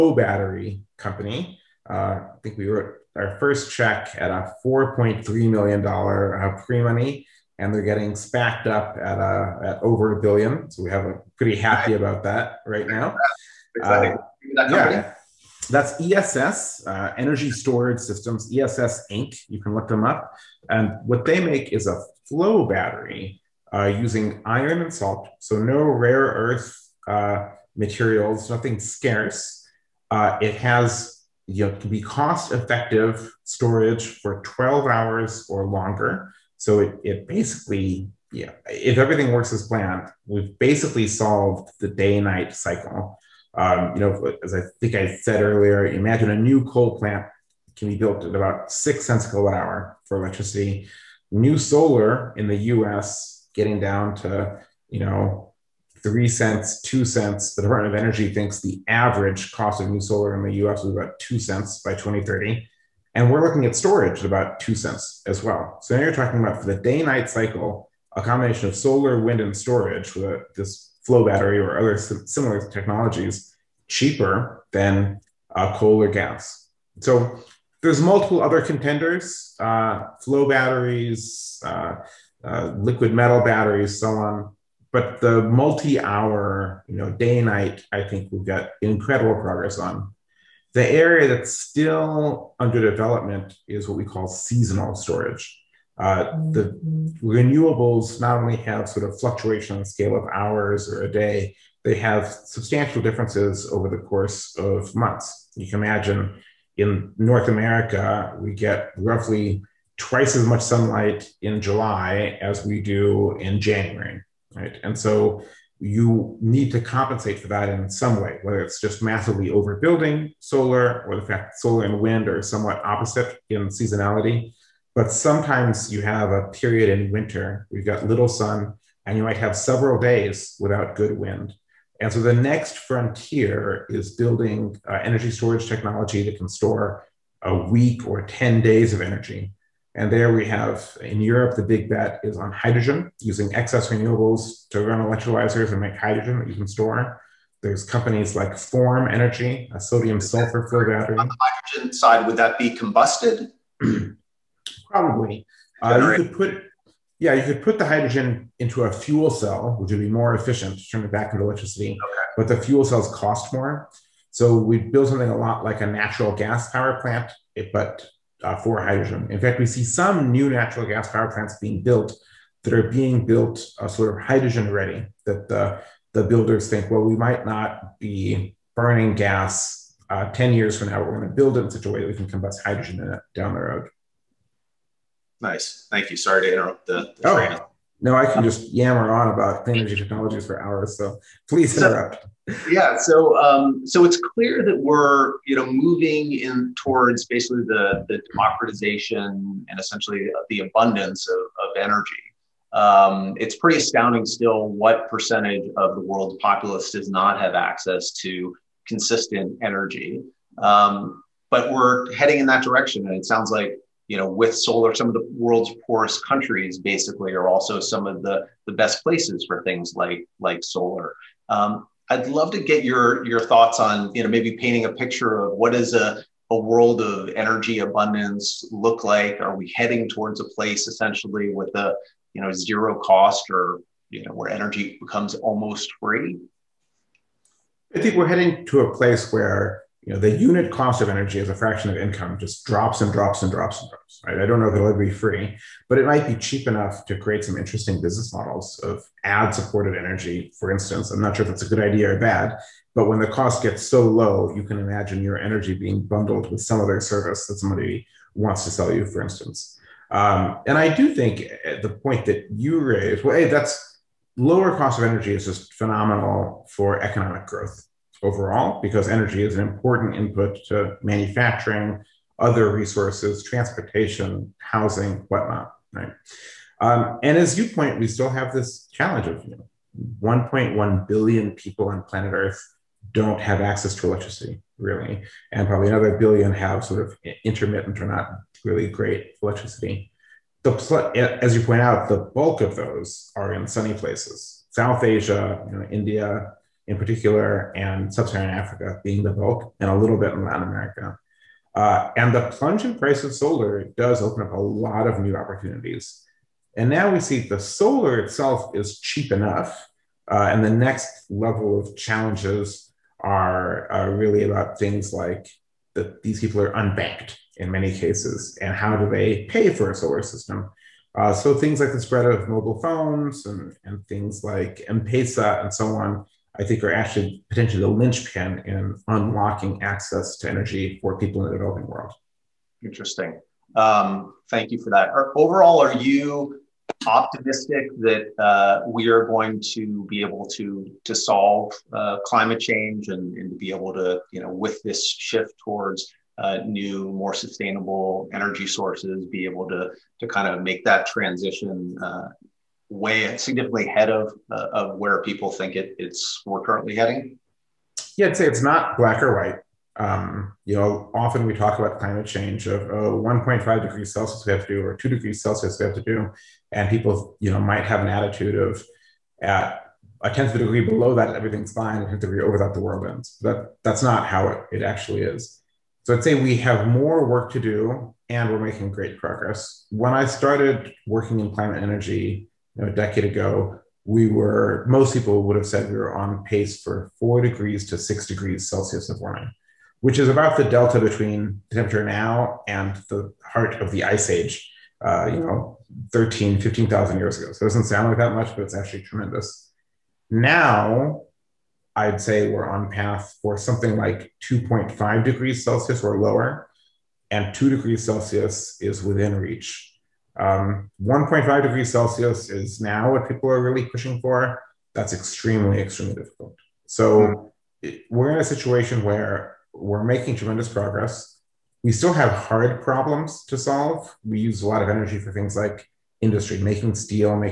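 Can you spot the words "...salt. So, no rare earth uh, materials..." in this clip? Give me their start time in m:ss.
0:24.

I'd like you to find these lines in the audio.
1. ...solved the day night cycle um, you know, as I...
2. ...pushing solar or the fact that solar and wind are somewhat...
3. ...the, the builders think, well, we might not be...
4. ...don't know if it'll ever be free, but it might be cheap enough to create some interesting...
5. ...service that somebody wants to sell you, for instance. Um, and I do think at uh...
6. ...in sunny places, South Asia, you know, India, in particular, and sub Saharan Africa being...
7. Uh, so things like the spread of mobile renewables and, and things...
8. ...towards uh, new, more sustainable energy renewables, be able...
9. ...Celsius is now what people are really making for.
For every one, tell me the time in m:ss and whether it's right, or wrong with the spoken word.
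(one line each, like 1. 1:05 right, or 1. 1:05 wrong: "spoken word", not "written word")
1. 0:41 right
2. 1:59 wrong: "overbuilding", not "pushing"
3. 2:55 right
4. 4:04 right
5. 4:16 right
6. 4:53 right
7. 5:21 wrong: "phones", not "renewables"
8. 5:45 wrong: "sources", not "renewables"
9. 6:51 wrong: "pushing", not "making".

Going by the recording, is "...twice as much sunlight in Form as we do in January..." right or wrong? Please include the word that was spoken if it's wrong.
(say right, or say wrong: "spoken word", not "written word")
wrong: "July", not "Form".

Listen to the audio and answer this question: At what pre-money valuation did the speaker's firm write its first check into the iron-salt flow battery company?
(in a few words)
$4.3 million.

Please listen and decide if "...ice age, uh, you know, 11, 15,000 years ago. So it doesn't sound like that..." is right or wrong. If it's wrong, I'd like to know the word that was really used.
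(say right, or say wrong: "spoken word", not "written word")
wrong: "13", not "11".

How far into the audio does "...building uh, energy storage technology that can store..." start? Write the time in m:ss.
2:14.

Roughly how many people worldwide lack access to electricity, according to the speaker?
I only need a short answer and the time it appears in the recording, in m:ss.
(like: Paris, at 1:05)
1.1 billion, at 4:40.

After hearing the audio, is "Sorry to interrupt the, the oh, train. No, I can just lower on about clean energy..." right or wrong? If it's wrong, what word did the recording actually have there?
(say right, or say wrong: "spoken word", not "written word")
wrong: "yammer", not "lower".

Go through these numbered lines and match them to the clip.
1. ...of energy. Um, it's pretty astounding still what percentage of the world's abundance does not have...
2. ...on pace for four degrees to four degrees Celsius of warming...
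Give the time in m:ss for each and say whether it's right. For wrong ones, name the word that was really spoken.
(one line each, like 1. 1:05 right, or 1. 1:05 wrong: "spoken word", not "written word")
1. 3:21 wrong: "populace", not "abundance"
2. 6:26 wrong: "six", not "four".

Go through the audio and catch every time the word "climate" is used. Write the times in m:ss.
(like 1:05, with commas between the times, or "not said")
5:42, 6:01, 6:21.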